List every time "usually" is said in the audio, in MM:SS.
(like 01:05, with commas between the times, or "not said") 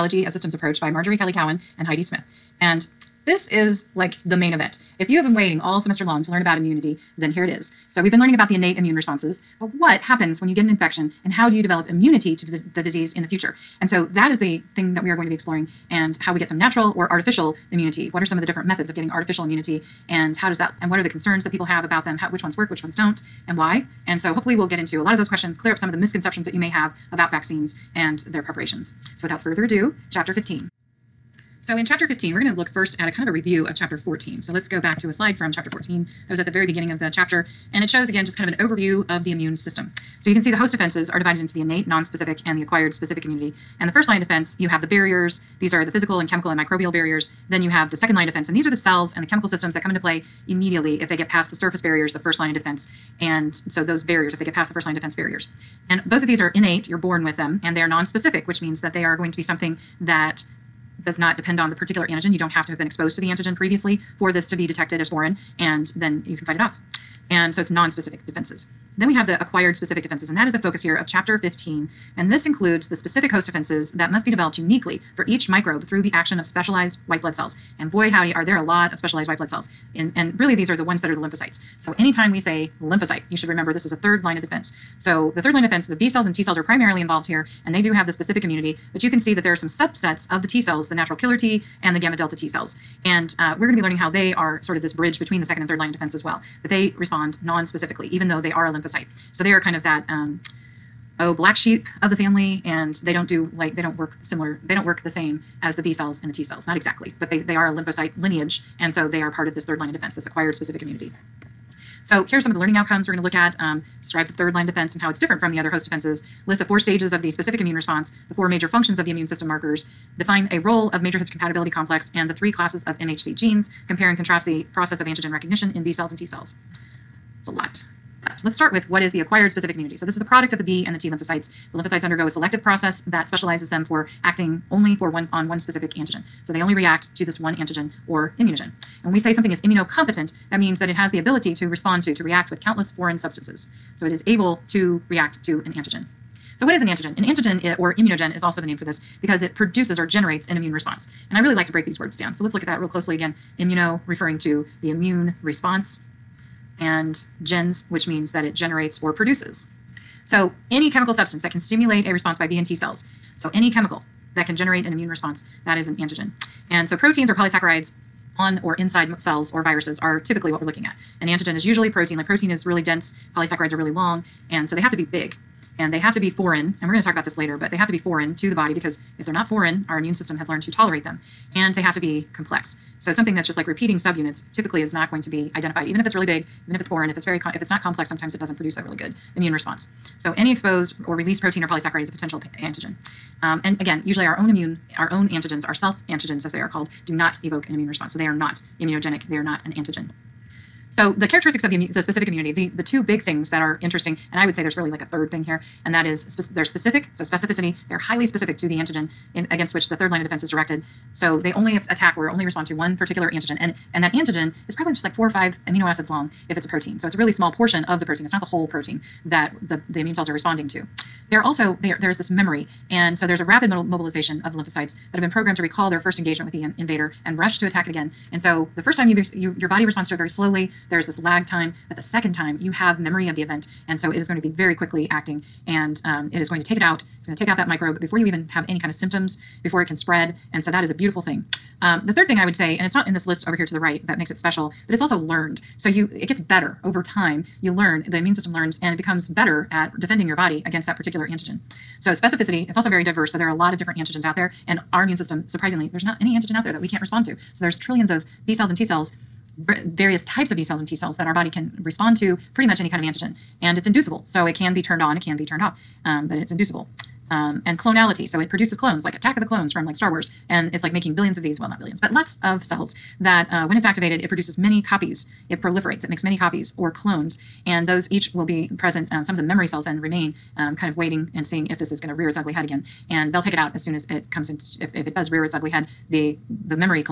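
02:51, 03:14.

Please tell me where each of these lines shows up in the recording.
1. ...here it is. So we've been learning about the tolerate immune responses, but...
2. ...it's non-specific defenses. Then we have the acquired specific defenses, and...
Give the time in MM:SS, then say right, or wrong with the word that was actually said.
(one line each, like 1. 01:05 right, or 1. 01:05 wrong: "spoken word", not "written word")
1. 00:07 wrong: "innate", not "tolerate"
2. 01:07 right.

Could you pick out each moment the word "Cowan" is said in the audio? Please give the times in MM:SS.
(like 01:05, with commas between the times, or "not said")
00:01.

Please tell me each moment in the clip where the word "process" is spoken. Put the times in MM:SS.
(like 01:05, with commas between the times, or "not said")
02:04, 02:12.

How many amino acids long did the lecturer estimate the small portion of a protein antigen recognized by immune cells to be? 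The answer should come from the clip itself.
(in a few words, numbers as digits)
4 or 5.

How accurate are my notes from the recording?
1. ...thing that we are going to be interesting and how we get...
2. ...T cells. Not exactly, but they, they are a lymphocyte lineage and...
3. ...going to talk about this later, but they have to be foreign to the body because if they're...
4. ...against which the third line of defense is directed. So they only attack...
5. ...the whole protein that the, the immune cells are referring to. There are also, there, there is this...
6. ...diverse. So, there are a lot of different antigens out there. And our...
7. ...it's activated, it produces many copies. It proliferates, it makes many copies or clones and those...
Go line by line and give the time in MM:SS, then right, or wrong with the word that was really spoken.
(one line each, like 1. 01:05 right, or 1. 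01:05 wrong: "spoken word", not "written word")
1. 00:14 wrong: "exploring", not "interesting"
2. 01:46 right
3. 02:56 right
4. 03:29 right
5. 03:38 wrong: "responding", not "referring"
6. 04:13 right
7. 04:33 right.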